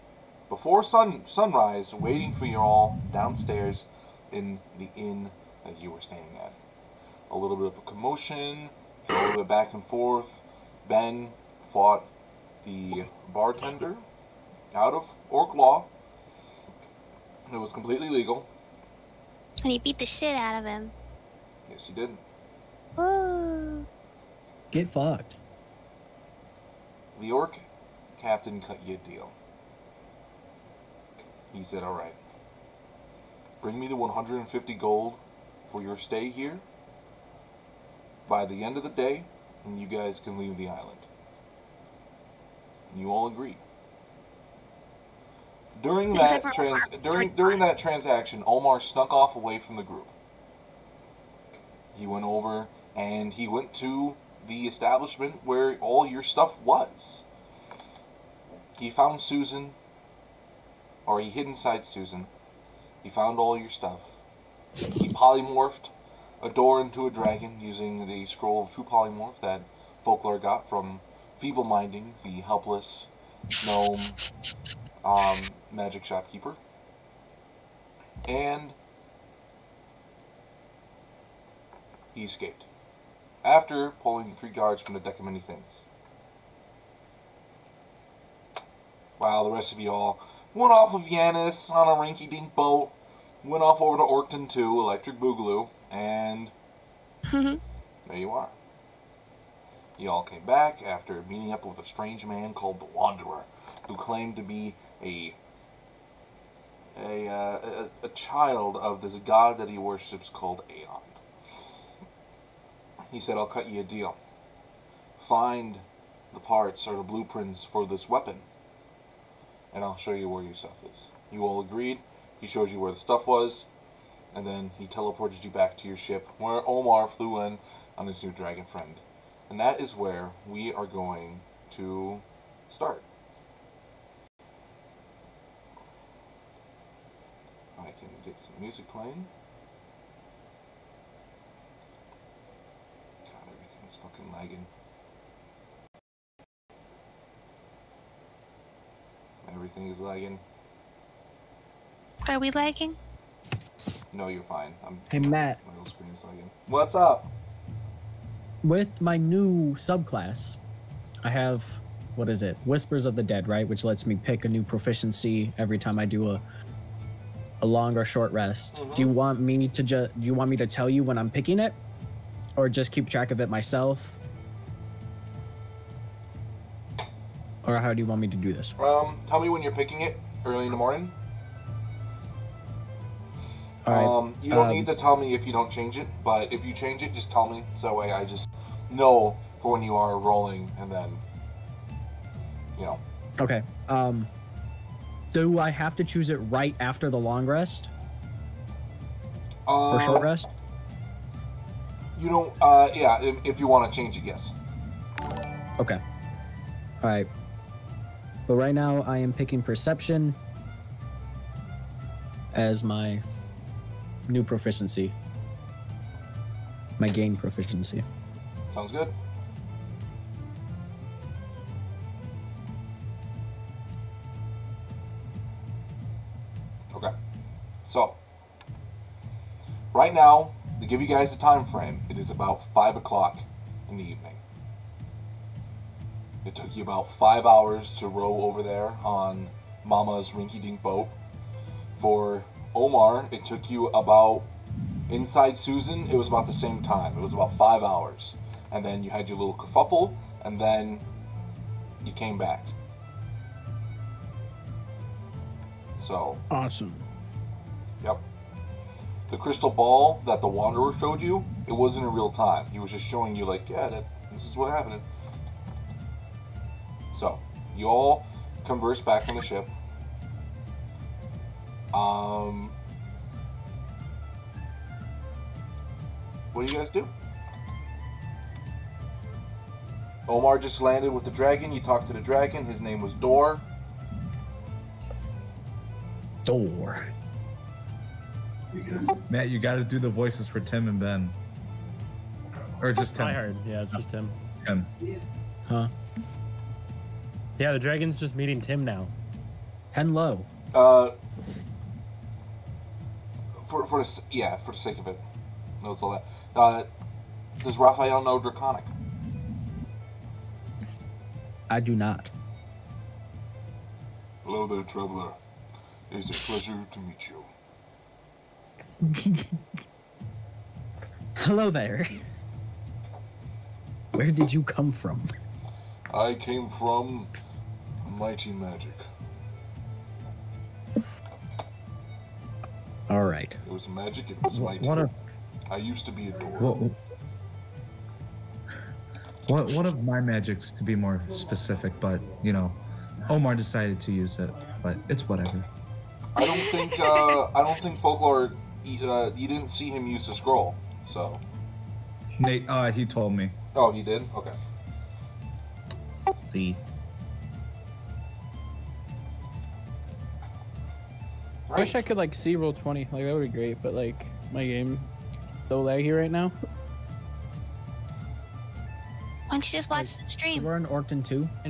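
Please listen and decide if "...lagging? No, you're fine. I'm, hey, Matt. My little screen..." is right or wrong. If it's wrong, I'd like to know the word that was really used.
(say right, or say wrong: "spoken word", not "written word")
right.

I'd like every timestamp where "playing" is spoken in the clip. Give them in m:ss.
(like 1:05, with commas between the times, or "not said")
2:18.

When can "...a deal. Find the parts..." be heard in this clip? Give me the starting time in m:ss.
1:53.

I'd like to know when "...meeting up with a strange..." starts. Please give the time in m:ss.
1:41.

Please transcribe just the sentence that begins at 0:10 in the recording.
Ben fought the bartender out of orc law.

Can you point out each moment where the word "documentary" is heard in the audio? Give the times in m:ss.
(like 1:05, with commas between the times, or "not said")
not said.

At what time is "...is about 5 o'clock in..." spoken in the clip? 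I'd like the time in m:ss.
3:52.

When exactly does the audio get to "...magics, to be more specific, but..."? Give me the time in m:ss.
5:40.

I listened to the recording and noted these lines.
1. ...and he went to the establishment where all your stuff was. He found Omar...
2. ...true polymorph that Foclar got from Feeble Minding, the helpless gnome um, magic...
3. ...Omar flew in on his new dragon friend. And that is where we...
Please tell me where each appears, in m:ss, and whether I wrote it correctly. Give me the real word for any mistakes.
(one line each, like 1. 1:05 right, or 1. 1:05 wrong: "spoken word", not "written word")
1. 0:52 wrong: "Susan", not "Omar"
2. 1:08 right
3. 2:06 right.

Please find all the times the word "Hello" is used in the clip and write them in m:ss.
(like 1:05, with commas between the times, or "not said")
5:14, 5:21.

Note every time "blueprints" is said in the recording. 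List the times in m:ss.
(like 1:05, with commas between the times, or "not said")
1:57.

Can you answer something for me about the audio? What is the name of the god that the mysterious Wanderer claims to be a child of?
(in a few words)
Aeon.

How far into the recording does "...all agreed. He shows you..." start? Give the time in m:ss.
2:01.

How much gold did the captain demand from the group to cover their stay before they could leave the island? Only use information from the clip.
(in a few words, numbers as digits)
150 gold.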